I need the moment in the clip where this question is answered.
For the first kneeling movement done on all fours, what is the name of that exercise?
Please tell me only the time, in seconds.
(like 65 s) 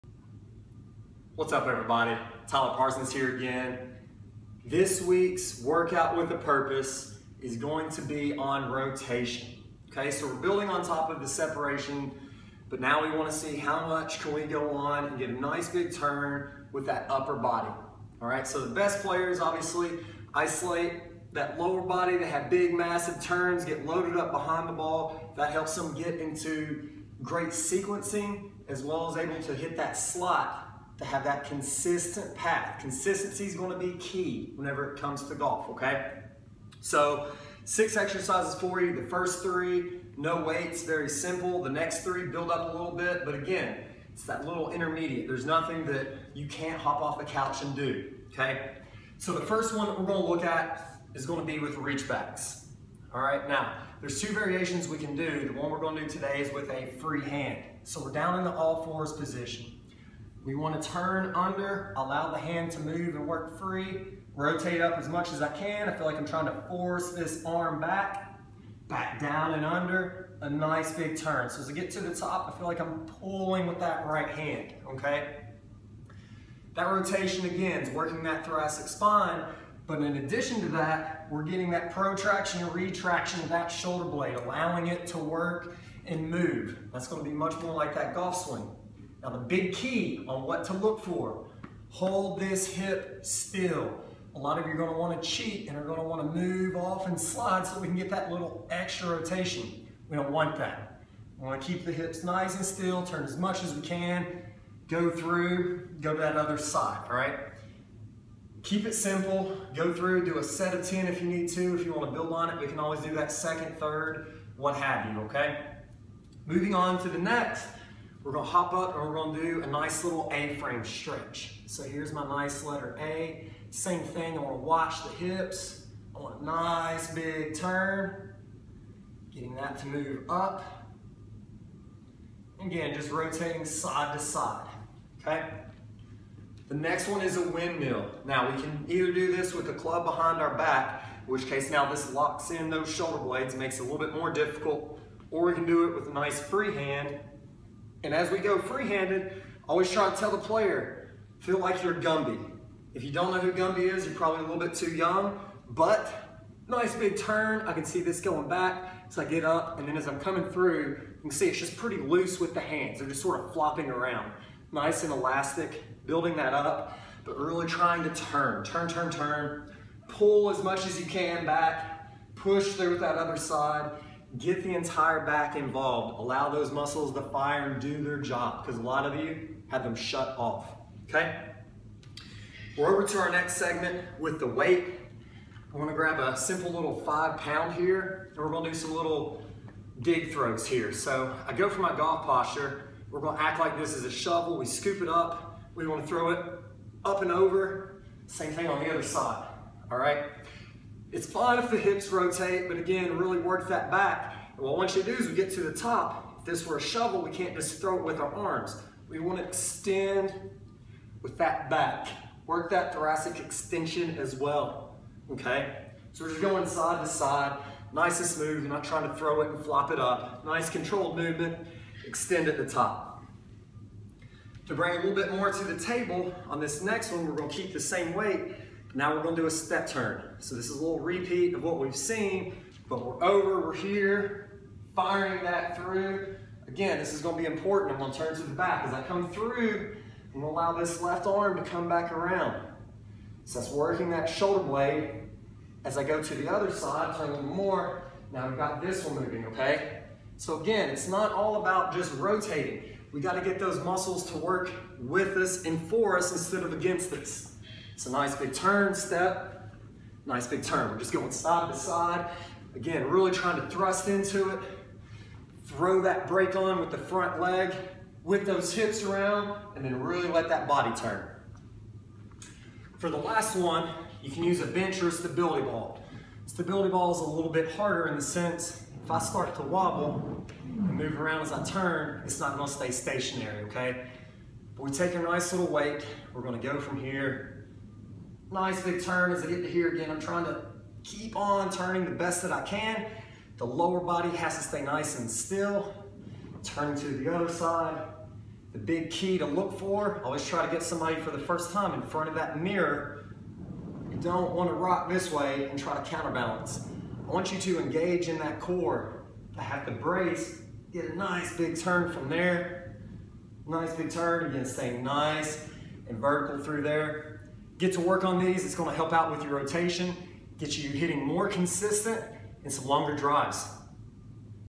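51 s.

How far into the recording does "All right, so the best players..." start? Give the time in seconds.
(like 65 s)
18 s.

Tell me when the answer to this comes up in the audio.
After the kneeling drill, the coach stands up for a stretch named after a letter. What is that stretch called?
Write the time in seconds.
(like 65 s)
120 s.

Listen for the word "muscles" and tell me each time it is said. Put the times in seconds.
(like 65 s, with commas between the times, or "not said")
176 s, 253 s.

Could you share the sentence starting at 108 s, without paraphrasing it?
Keep it simple, go through, do a set of 10 if you need to.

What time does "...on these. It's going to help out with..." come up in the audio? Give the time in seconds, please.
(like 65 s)
318 s.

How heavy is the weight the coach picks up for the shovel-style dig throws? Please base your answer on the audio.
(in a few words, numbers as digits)
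5 pounds.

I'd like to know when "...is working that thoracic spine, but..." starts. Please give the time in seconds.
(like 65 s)
77 s.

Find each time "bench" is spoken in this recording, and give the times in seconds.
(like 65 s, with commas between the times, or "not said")
274 s.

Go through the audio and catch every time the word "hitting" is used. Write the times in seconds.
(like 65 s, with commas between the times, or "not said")
320 s.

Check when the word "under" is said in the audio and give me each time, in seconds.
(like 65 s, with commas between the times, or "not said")
61 s, 69 s.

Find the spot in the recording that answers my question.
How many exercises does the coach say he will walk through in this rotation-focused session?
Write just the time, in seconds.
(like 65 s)
37 s.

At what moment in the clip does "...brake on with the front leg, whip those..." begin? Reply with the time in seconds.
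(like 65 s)
266 s.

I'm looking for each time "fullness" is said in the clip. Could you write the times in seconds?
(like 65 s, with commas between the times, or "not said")
not said.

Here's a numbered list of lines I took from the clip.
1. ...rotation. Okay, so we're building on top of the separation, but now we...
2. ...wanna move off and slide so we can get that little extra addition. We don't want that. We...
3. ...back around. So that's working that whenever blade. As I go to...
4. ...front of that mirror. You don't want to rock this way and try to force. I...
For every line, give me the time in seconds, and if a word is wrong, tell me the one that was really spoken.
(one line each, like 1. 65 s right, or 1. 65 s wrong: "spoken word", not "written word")
1. 8 s right
2. 96 s wrong: "rotation", not "addition"
3. 241 s wrong: "shoulder", not "whenever"
4. 302 s wrong: "counterbalance", not "force".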